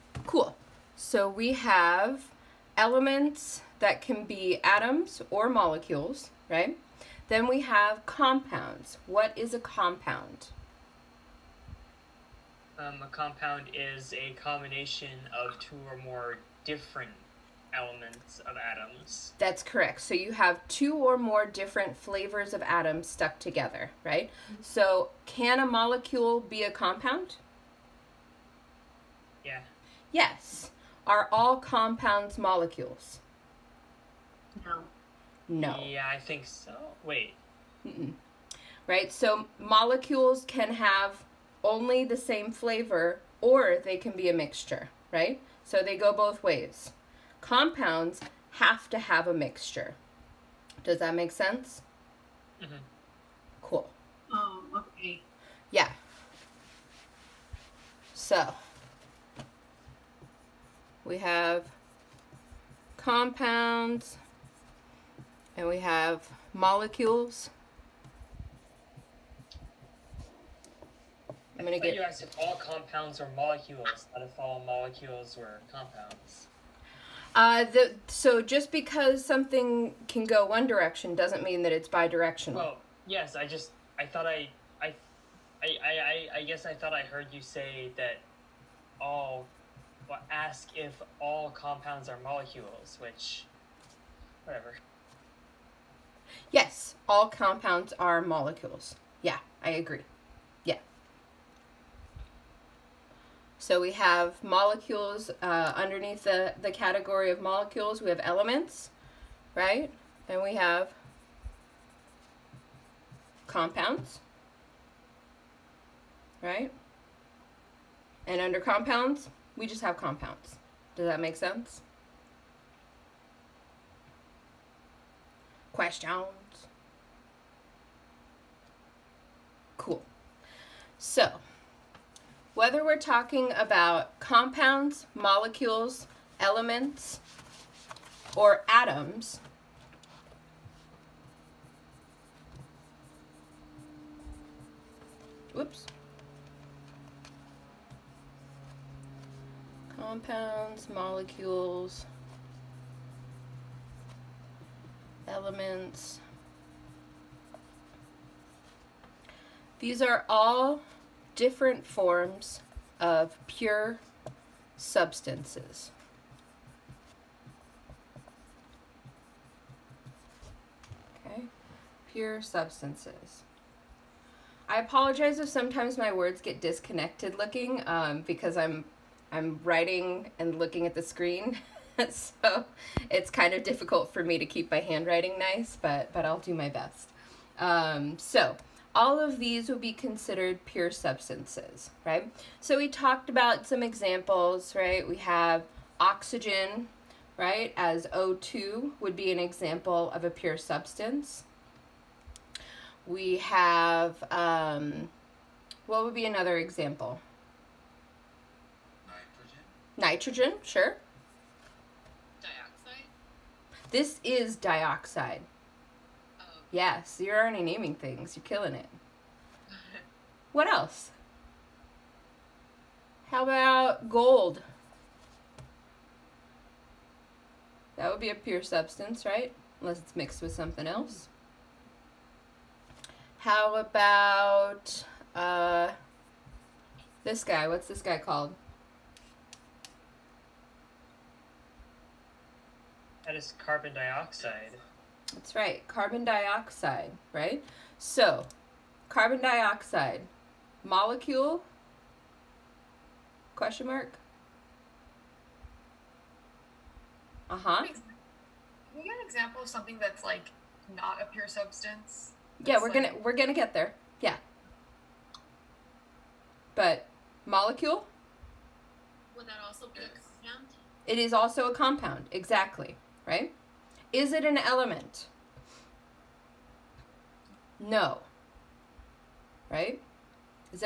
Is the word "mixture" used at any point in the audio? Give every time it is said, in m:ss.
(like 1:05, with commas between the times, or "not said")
0:44, 0:49.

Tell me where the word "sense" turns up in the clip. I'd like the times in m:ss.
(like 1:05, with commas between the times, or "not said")
0:51, 2:01.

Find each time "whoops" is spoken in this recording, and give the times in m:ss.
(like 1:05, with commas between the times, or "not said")
2:25.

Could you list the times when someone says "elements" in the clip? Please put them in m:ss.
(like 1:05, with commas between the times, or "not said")
0:02, 0:17, 1:48, 2:16, 2:35, 4:34.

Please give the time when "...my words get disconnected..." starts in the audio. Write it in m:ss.
2:55.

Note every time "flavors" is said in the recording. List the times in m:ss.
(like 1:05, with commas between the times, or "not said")
0:21, 0:42.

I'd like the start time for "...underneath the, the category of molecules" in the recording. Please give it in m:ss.
1:45.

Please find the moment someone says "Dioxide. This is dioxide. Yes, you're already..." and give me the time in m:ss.
3:32.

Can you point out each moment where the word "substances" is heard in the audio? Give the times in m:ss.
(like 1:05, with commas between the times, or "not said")
2:44, 2:52, 3:10, 3:20, 3:48, 4:21.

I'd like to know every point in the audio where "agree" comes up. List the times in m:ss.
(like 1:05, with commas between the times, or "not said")
1:39.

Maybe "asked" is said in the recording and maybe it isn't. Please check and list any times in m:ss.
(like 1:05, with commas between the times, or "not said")
1:12.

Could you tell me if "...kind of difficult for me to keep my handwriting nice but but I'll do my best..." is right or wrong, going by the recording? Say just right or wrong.
right.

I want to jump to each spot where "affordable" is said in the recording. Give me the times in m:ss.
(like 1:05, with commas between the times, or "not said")
not said.